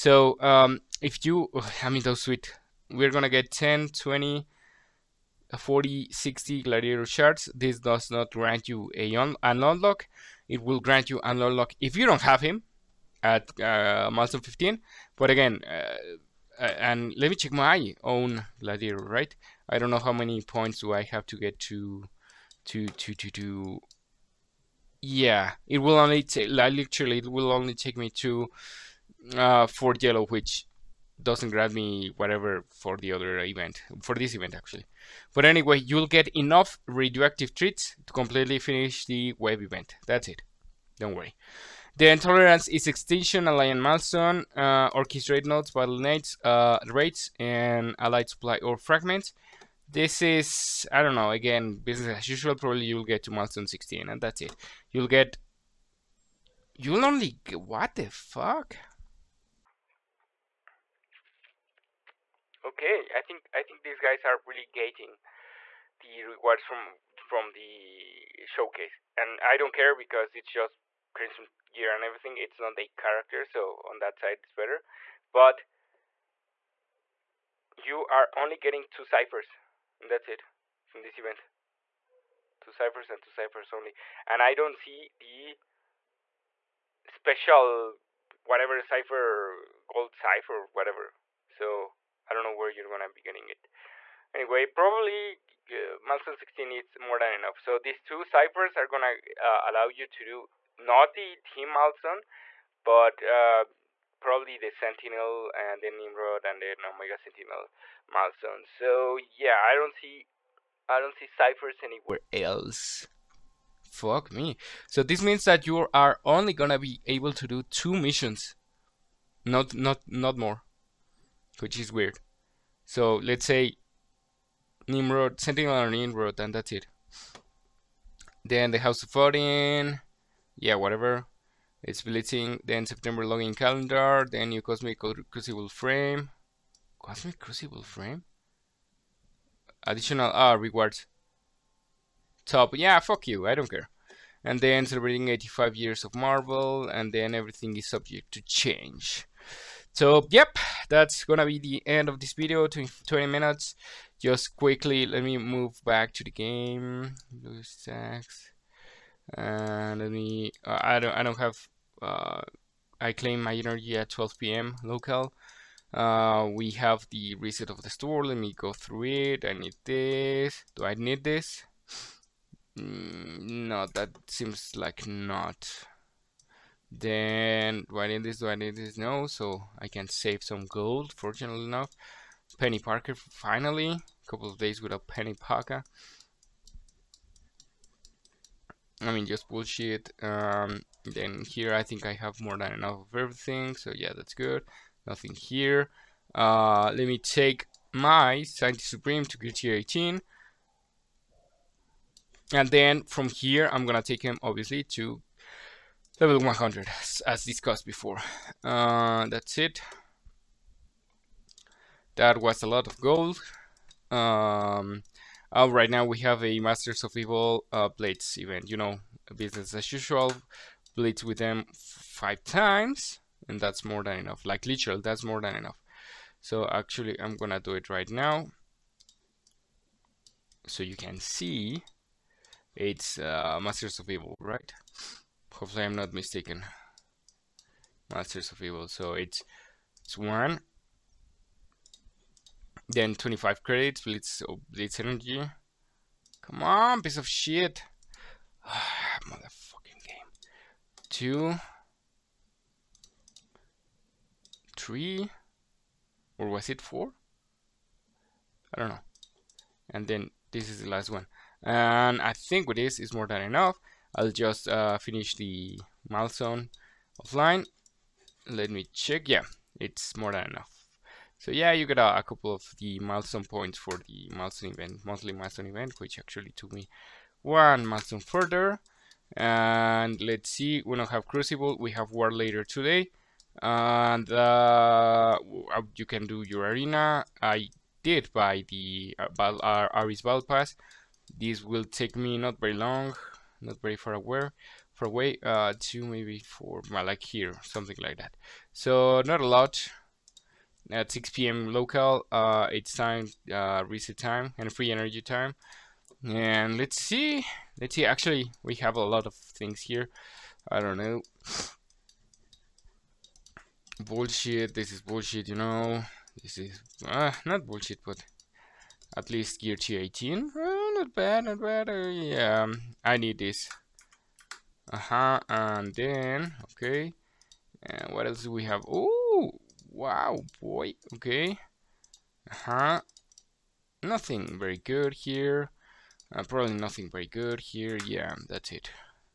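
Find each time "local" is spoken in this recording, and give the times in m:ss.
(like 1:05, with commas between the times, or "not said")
2:44, 5:01.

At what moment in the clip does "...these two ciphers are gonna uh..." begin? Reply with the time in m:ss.
1:37.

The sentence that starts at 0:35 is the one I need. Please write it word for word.
But anyway, you'll get enough radioactive treats to completely finish the wave event.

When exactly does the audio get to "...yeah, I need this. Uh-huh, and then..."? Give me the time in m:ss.
5:22.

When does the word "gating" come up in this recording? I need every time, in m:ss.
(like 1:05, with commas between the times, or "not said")
1:04.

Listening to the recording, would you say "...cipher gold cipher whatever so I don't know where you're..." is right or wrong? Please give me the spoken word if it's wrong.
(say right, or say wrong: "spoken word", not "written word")
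right.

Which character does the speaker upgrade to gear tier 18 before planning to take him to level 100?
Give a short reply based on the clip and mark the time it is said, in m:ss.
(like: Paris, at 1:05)
Scientist Supreme, at 3:18.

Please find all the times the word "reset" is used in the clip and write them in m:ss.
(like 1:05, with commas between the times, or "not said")
2:47, 5:03.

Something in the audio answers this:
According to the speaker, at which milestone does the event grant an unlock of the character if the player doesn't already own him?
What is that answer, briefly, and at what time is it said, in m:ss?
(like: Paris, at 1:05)
15, at 0:14.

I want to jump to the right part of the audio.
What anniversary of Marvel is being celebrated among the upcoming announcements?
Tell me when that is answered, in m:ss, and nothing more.
2:25.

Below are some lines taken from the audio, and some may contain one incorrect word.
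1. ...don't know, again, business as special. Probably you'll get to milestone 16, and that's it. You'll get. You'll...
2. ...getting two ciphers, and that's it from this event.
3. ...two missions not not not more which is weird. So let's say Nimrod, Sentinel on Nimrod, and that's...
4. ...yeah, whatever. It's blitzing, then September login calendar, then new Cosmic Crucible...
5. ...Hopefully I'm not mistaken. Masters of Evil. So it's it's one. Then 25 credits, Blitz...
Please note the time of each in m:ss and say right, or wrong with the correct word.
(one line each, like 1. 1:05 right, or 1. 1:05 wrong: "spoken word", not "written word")
1. 0:51 wrong: "usual", not "special"
2. 1:18 right
3. 1:57 right
4. 2:10 right
5. 3:55 right.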